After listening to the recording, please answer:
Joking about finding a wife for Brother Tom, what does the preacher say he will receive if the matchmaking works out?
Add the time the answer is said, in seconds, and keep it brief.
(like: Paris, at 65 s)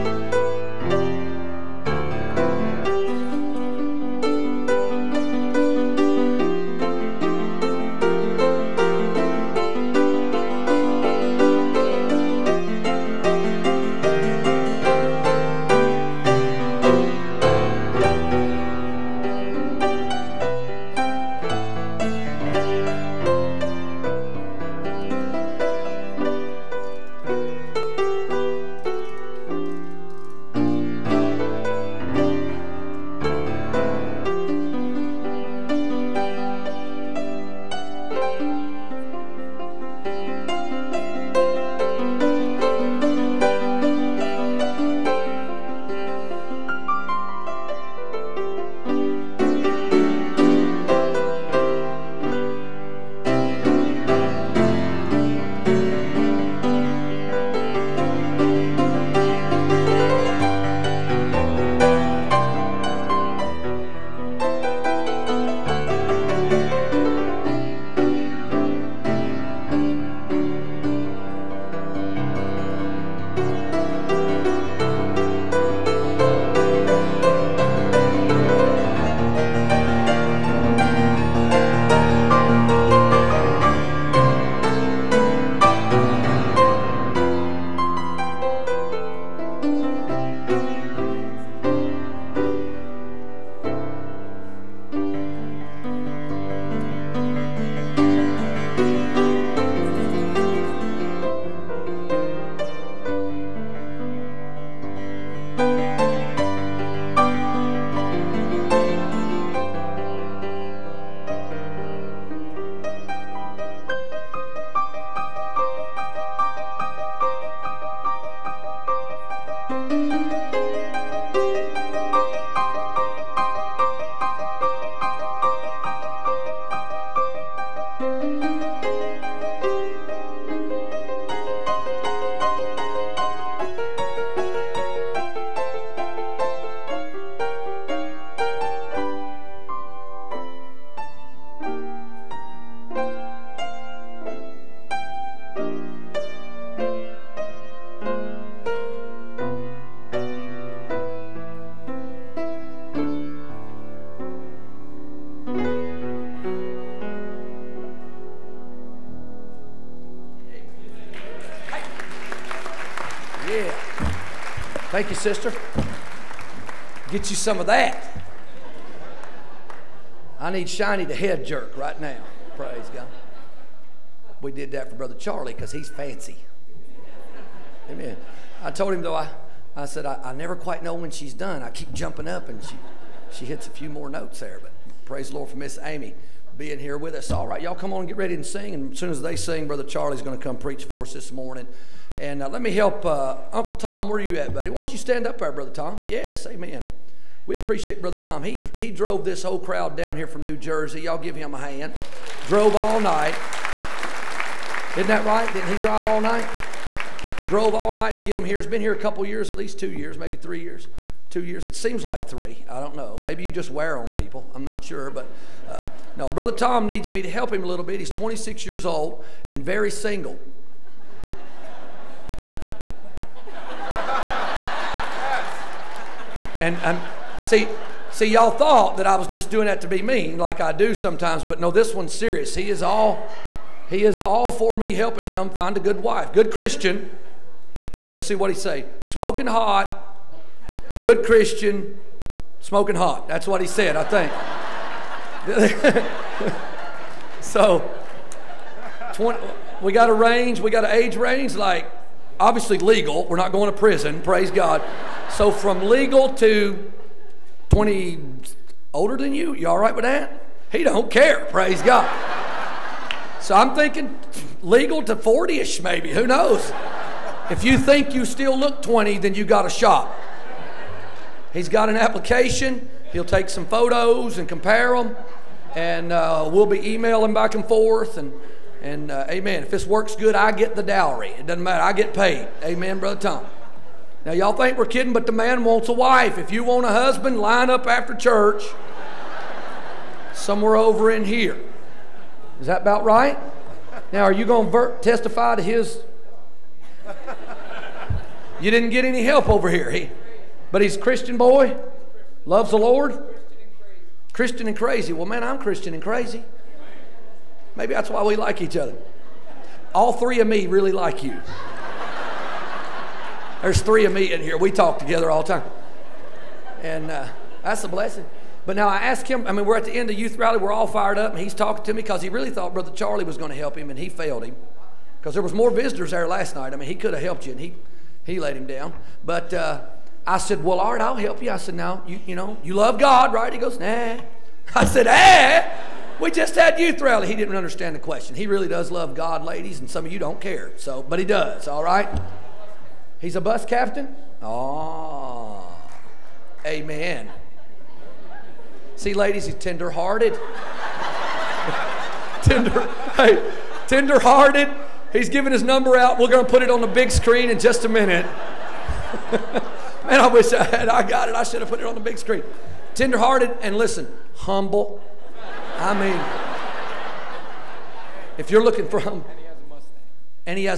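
The dowry, at 280 s.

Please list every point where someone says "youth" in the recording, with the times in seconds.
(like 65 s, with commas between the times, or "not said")
320 s, 336 s.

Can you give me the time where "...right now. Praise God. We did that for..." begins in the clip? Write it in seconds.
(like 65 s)
171 s.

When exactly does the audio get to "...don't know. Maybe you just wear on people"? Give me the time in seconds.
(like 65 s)
212 s.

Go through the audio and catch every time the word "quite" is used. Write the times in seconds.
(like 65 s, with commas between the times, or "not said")
180 s.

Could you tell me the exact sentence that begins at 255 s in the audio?
So from legal to 20 older than you, you all right with that?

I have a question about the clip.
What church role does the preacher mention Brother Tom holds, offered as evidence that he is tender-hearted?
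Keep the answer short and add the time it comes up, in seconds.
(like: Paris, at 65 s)
Bus captain, at 343 s.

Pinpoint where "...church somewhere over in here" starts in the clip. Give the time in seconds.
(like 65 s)
288 s.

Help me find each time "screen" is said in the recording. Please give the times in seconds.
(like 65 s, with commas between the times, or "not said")
357 s, 362 s.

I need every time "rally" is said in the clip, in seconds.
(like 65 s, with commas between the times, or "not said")
320 s, 337 s.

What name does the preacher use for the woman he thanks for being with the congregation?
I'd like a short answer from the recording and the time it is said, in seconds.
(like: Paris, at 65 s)
Miss Amy, at 185 s.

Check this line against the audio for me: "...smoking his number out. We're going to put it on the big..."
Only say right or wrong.
wrong.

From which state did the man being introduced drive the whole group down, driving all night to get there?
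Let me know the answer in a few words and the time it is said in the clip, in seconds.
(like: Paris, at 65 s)
New Jersey, at 200 s.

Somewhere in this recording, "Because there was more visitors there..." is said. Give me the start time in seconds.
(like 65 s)
325 s.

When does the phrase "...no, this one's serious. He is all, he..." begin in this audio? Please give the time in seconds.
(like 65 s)
231 s.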